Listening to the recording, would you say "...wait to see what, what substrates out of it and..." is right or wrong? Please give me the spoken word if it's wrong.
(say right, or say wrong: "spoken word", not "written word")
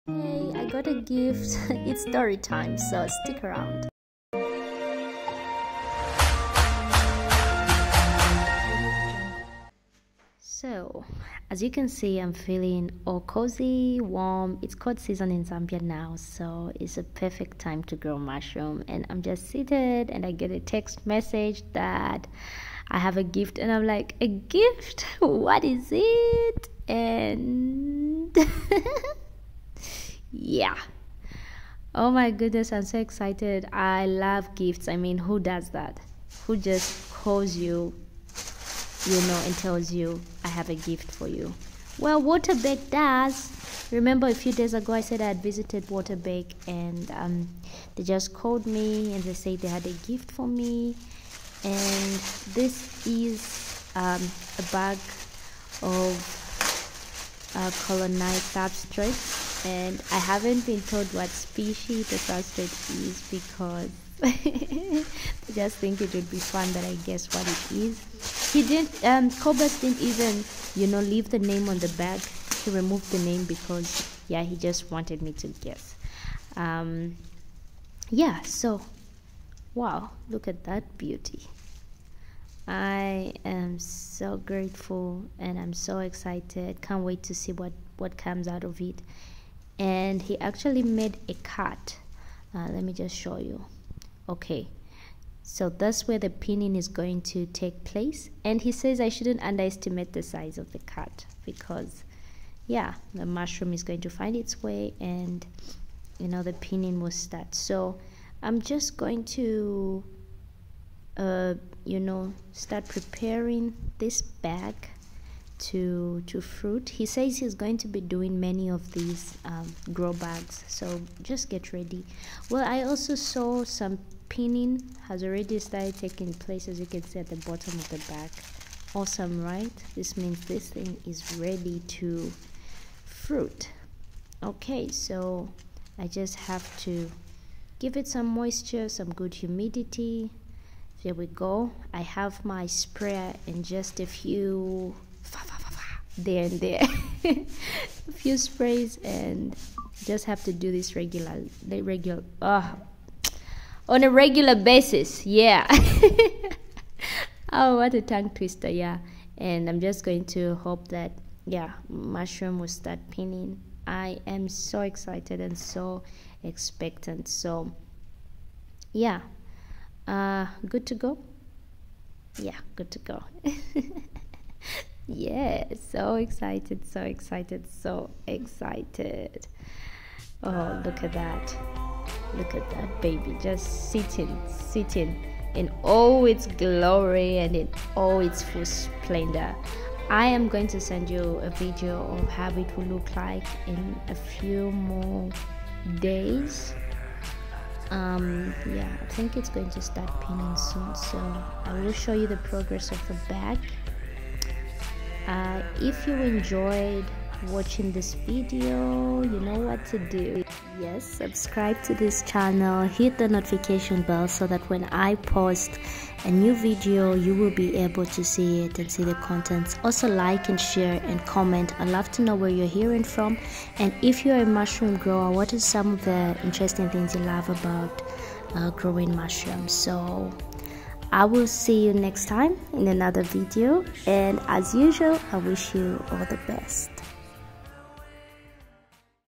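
wrong: "comes", not "substrates".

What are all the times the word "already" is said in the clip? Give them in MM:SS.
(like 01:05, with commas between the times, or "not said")
02:05.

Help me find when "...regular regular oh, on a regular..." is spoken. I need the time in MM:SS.
02:30.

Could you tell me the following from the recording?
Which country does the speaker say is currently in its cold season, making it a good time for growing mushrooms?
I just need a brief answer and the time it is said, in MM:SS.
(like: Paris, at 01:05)
Zambia, at 00:15.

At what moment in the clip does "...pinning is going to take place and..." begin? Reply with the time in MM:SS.
01:36.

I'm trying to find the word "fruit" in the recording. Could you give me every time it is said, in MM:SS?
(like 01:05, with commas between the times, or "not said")
01:56, 02:13.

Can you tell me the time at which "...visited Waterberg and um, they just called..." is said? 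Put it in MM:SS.
00:45.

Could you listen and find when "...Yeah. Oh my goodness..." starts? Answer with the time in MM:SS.
00:30.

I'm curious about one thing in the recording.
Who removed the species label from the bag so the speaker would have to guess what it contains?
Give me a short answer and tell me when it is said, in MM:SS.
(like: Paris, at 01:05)
Cobus, at 01:09.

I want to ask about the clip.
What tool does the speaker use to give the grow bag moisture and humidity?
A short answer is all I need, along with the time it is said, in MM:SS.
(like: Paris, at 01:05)
Sprayer, at 02:22.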